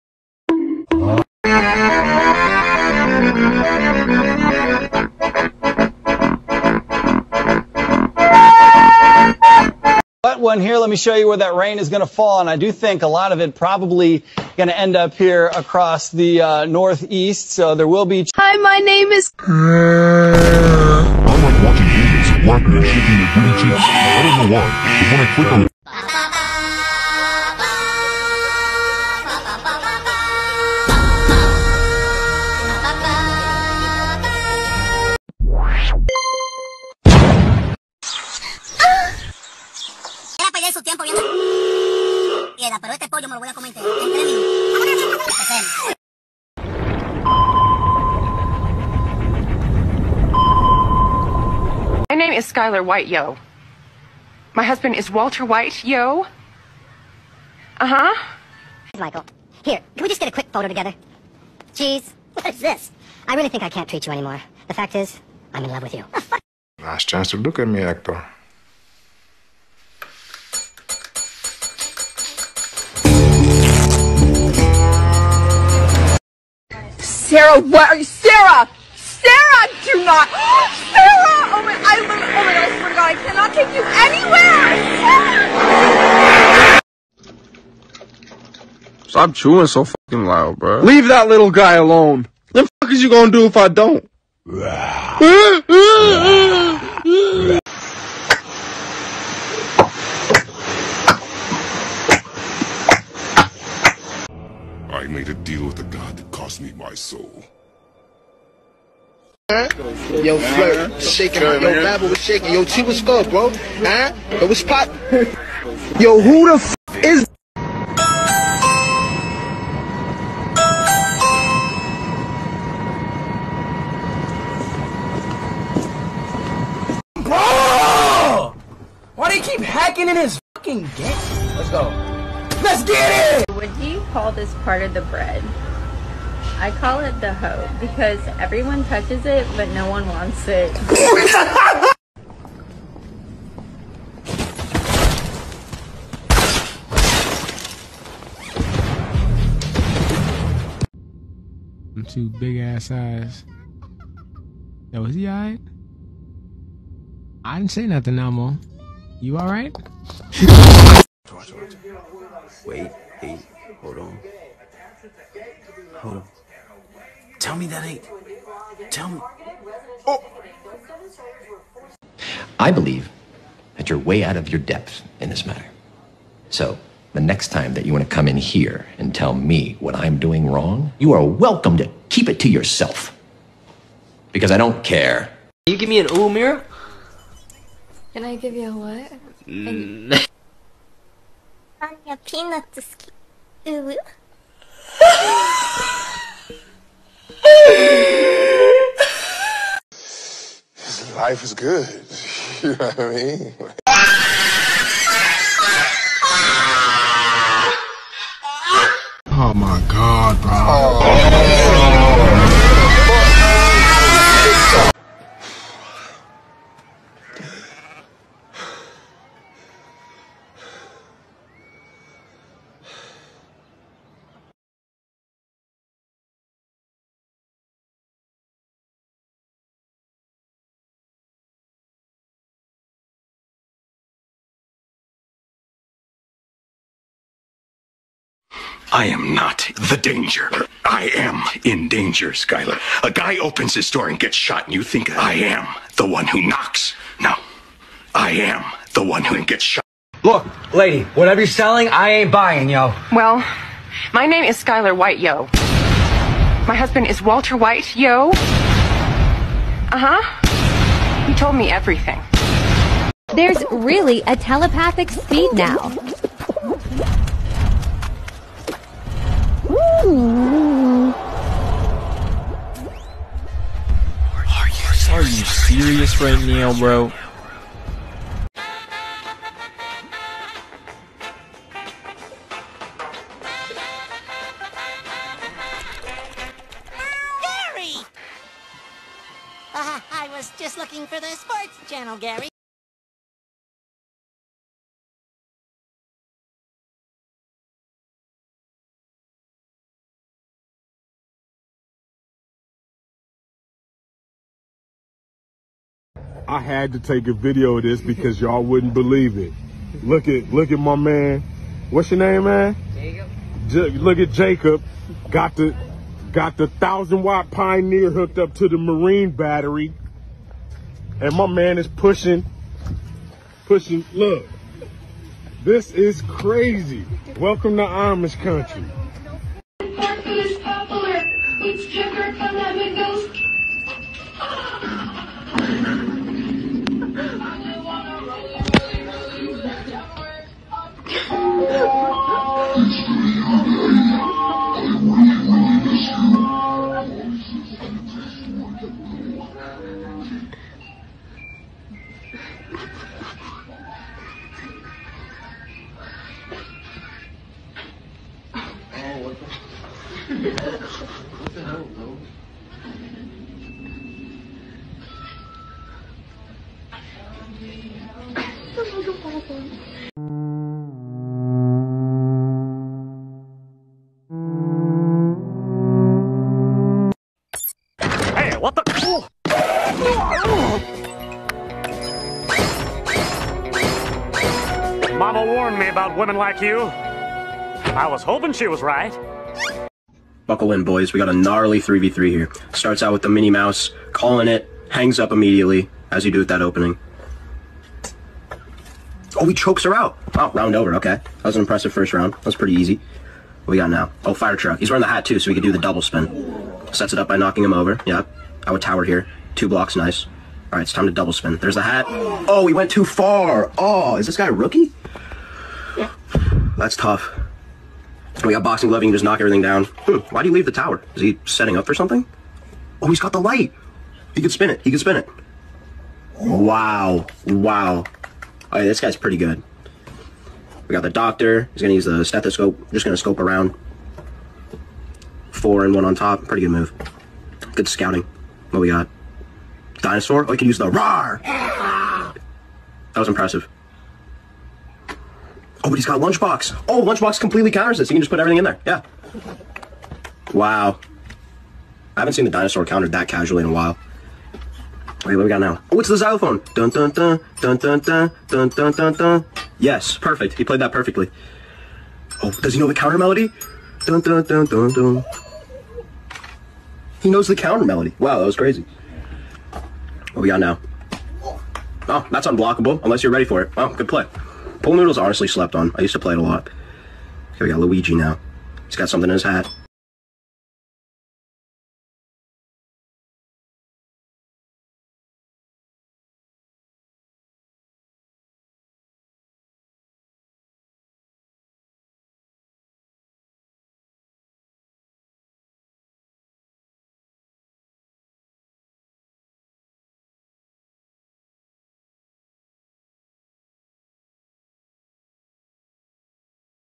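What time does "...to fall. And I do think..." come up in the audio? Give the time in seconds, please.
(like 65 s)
11 s.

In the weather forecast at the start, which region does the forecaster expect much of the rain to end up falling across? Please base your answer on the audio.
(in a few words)
Northeast.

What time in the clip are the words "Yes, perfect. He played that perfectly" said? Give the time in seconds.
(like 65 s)
459 s.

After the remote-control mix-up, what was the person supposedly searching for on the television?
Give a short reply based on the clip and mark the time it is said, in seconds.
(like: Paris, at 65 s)
Sports channel, at 291 s.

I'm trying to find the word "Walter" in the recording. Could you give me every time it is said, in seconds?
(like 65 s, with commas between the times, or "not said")
55 s, 257 s.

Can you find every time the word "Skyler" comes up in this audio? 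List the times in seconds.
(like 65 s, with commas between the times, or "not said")
52 s, 242 s, 254 s.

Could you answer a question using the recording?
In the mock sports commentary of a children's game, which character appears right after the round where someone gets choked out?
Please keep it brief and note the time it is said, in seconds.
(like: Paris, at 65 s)
Fire truck, at 404 s.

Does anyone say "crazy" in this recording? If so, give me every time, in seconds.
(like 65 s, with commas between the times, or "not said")
326 s, 468 s.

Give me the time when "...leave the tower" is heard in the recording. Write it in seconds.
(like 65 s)
420 s.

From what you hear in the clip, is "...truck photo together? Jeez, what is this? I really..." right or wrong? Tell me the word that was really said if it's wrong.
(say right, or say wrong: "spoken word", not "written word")
wrong: "quick", not "truck".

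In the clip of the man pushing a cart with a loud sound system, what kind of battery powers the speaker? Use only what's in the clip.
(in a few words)
Marine battery.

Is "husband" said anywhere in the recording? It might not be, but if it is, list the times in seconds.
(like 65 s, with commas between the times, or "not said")
54 s, 256 s.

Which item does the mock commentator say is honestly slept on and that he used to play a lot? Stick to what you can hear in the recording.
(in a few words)
Pool noodles.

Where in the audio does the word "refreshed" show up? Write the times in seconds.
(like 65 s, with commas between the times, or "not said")
not said.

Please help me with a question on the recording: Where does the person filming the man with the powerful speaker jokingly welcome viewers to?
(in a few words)
Amish country.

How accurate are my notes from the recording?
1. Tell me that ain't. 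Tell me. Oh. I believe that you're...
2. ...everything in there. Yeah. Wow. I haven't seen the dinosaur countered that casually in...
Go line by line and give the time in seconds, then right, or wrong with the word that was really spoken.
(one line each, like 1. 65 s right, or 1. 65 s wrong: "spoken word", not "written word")
1. 167 s right
2. 448 s right.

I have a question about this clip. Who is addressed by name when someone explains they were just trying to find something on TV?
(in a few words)
Gary.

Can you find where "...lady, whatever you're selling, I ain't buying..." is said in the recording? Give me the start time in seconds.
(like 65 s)
250 s.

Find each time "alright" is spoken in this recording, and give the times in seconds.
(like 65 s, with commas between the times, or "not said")
155 s, 159 s.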